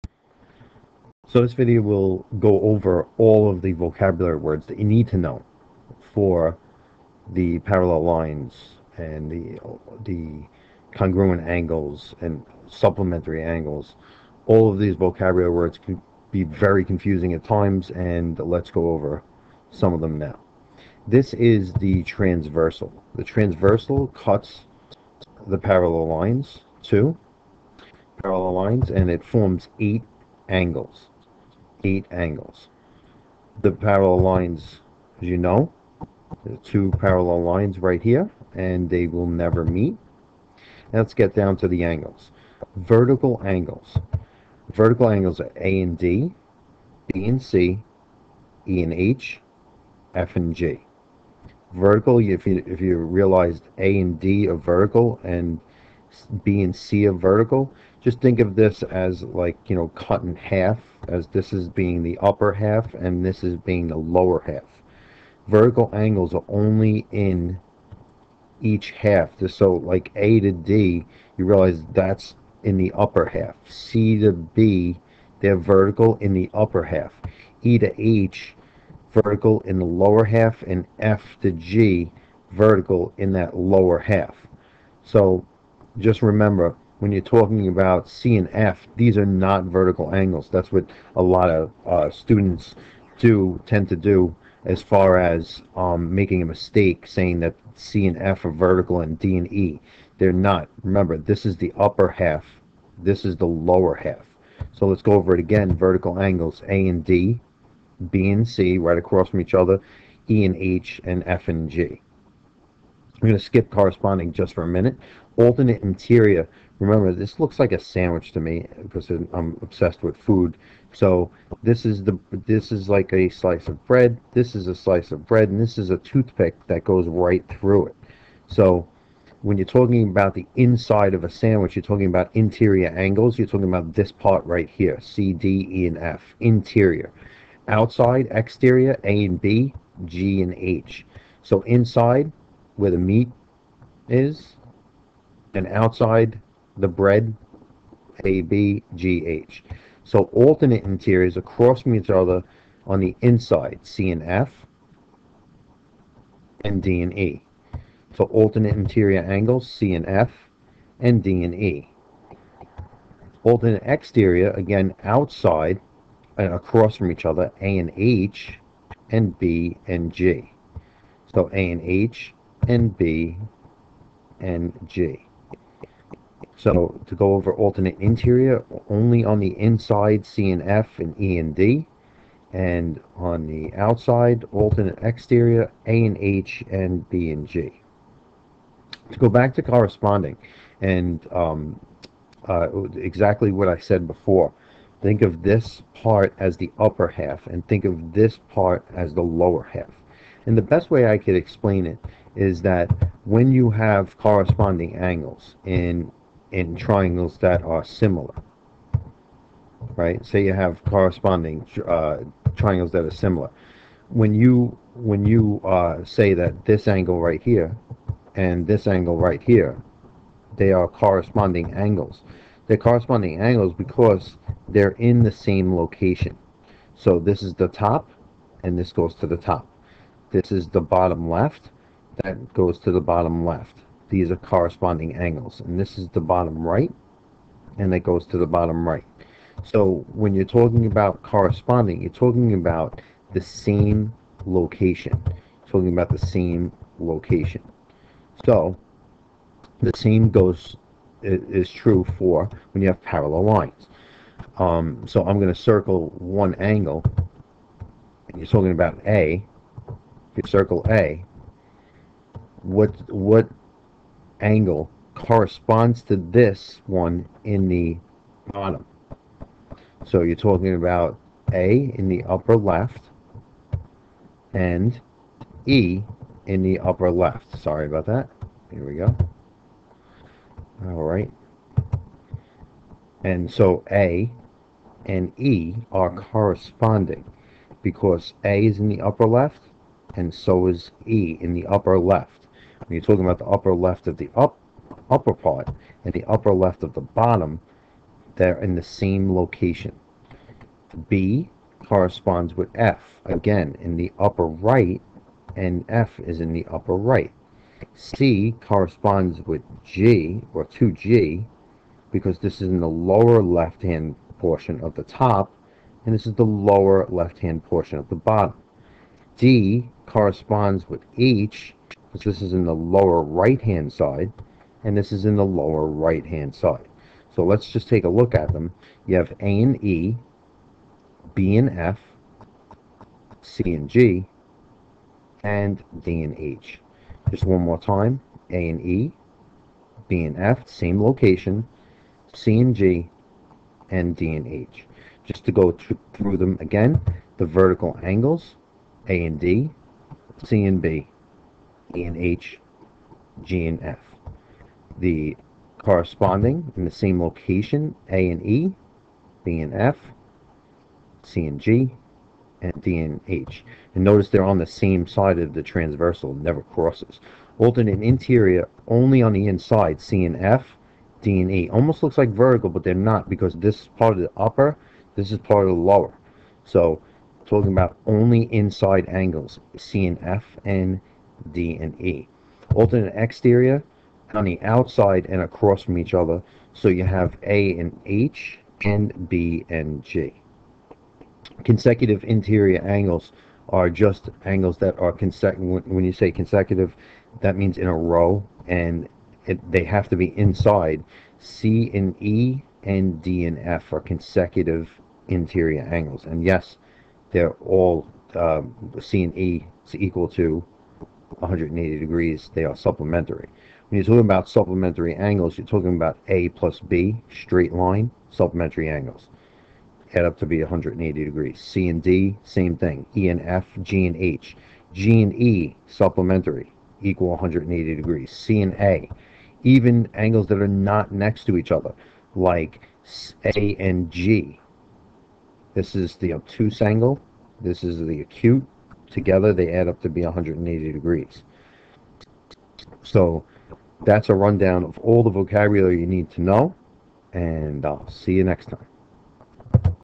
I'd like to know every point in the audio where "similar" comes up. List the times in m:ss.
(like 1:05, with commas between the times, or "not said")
3:27, 3:33.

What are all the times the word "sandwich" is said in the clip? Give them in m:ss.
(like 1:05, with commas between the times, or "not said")
1:57, 2:11.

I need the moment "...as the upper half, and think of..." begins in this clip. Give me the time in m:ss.
3:16.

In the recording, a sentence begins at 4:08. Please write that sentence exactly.
So the same goes is true for when you have parallel lines.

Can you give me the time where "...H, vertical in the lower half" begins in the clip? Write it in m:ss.
1:17.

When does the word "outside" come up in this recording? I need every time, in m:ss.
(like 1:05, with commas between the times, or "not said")
2:17, 2:25, 2:45, 3:03, 6:24.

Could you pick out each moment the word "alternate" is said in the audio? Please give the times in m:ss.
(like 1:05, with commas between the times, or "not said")
1:55, 2:30, 2:38, 2:43, 2:57, 3:04, 6:07, 6:22.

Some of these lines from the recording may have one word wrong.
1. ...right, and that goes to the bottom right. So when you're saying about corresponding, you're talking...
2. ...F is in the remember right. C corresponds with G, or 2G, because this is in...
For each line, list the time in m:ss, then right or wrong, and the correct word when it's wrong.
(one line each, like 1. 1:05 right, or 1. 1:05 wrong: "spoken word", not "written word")
1. 3:56 wrong: "talking", not "saying"
2. 5:05 wrong: "upper", not "remember".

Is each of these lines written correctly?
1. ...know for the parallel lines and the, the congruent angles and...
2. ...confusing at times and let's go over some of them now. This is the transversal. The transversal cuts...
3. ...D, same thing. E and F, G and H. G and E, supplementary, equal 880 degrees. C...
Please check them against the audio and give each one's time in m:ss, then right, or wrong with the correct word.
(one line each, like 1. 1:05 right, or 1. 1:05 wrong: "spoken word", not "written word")
1. 0:05 right
2. 0:16 right
3. 7:02 wrong: "180", not "880".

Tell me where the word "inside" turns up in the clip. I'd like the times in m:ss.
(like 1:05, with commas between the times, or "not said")
2:10, 2:21, 2:33, 2:59, 6:09, 6:18, 6:40.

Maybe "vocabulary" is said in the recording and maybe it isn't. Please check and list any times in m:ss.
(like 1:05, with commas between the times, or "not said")
0:03, 0:14, 7:25.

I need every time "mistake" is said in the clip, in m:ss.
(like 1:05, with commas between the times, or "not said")
1:36.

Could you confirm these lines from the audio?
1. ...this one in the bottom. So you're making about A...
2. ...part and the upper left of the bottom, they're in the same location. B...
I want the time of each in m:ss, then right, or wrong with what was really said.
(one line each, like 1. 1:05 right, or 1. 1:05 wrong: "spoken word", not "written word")
1. 4:26 wrong: "talking", not "making"
2. 4:55 right.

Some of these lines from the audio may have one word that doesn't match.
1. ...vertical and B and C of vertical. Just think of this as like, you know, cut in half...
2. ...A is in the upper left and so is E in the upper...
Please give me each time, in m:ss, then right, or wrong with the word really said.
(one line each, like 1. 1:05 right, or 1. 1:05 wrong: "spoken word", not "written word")
1. 0:54 right
2. 4:48 right.